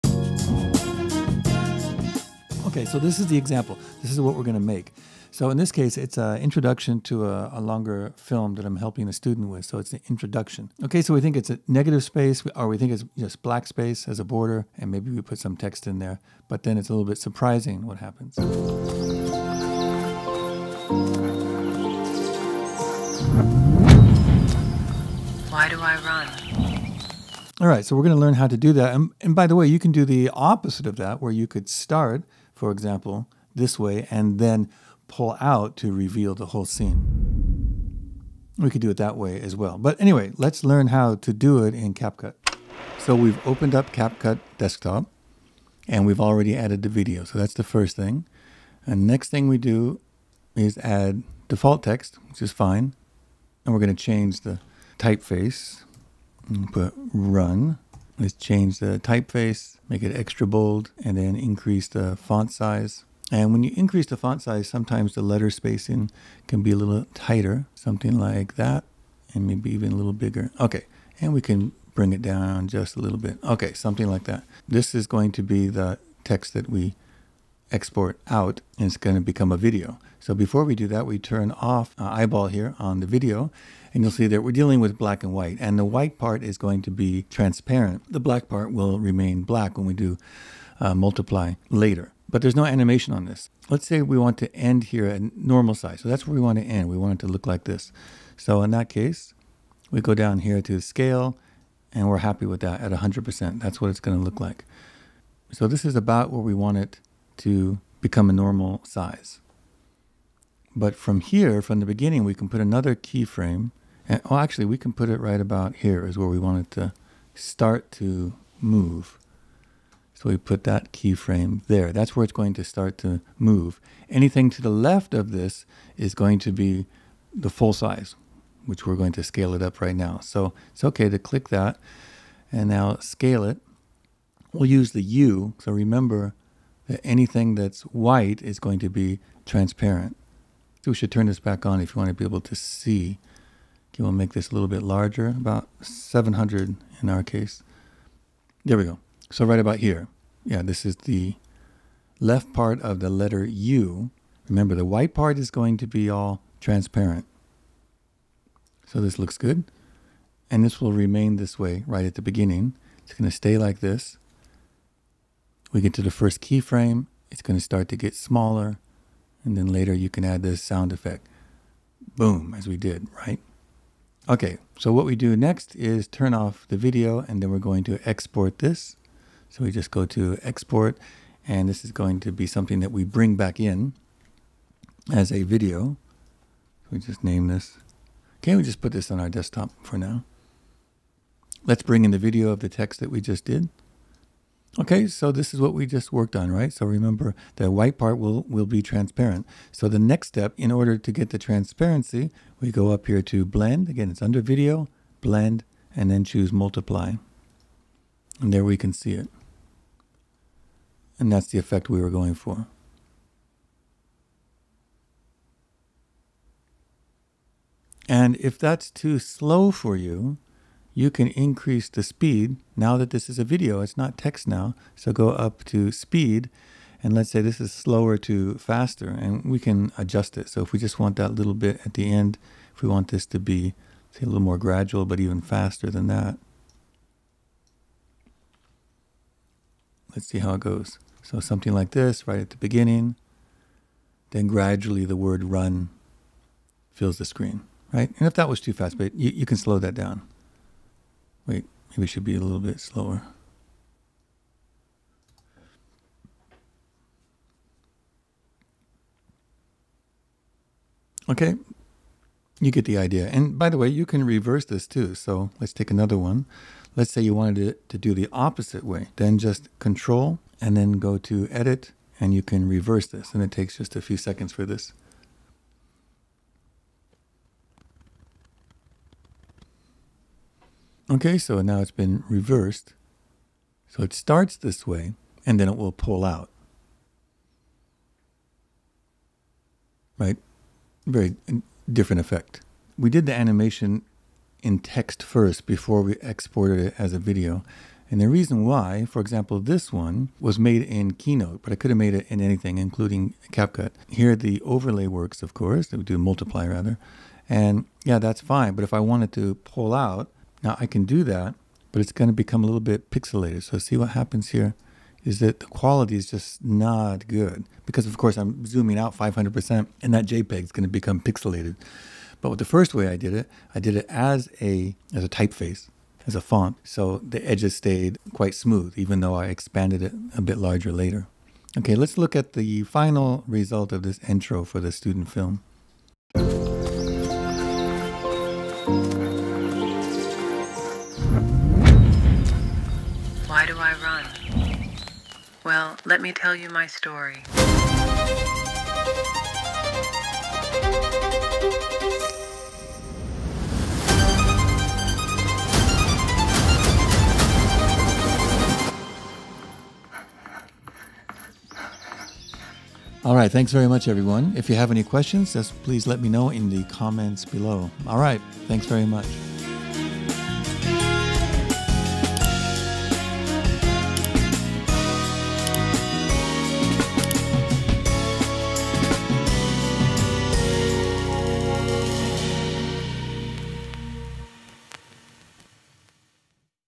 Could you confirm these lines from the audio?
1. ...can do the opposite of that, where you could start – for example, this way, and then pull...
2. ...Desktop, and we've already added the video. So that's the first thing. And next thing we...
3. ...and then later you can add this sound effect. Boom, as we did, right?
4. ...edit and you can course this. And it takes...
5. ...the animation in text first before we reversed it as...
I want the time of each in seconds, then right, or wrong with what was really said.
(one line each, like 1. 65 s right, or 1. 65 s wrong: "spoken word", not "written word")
1. 29 s right
2. 44 s right
3. 169 s right
4. 271 s wrong: "reverse", not "course"
5. 293 s wrong: "exported", not "reversed".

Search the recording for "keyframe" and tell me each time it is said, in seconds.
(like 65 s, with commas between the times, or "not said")
112 s, 120 s, 166 s.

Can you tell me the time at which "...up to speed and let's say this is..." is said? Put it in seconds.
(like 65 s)
225 s.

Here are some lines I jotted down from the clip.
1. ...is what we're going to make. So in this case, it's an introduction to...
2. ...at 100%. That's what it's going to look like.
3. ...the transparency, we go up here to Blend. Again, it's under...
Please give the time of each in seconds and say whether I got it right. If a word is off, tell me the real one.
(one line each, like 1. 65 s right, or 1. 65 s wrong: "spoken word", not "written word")
1. 4 s right
2. 102 s right
3. 201 s right.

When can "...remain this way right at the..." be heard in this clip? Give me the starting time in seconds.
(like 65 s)
160 s.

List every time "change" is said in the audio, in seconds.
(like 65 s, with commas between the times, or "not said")
54 s, 58 s.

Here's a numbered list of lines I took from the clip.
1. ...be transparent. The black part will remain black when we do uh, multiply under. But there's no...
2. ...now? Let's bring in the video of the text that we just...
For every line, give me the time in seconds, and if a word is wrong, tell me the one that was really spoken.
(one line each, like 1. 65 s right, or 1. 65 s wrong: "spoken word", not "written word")
1. 86 s wrong: "later", not "under"
2. 189 s right.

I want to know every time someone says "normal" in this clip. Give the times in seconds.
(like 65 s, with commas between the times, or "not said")
95 s, 108 s.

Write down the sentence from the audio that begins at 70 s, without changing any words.
Okay, and we can bring it down just a little bit.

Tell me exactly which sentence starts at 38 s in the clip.
We could do it that way as well.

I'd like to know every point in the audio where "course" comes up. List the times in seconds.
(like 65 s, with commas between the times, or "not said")
305 s, 318 s.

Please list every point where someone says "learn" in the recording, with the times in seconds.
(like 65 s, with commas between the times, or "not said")
28 s, 40 s.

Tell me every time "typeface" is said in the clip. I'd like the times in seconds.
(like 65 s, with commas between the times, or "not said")
54 s, 59 s, 325 s.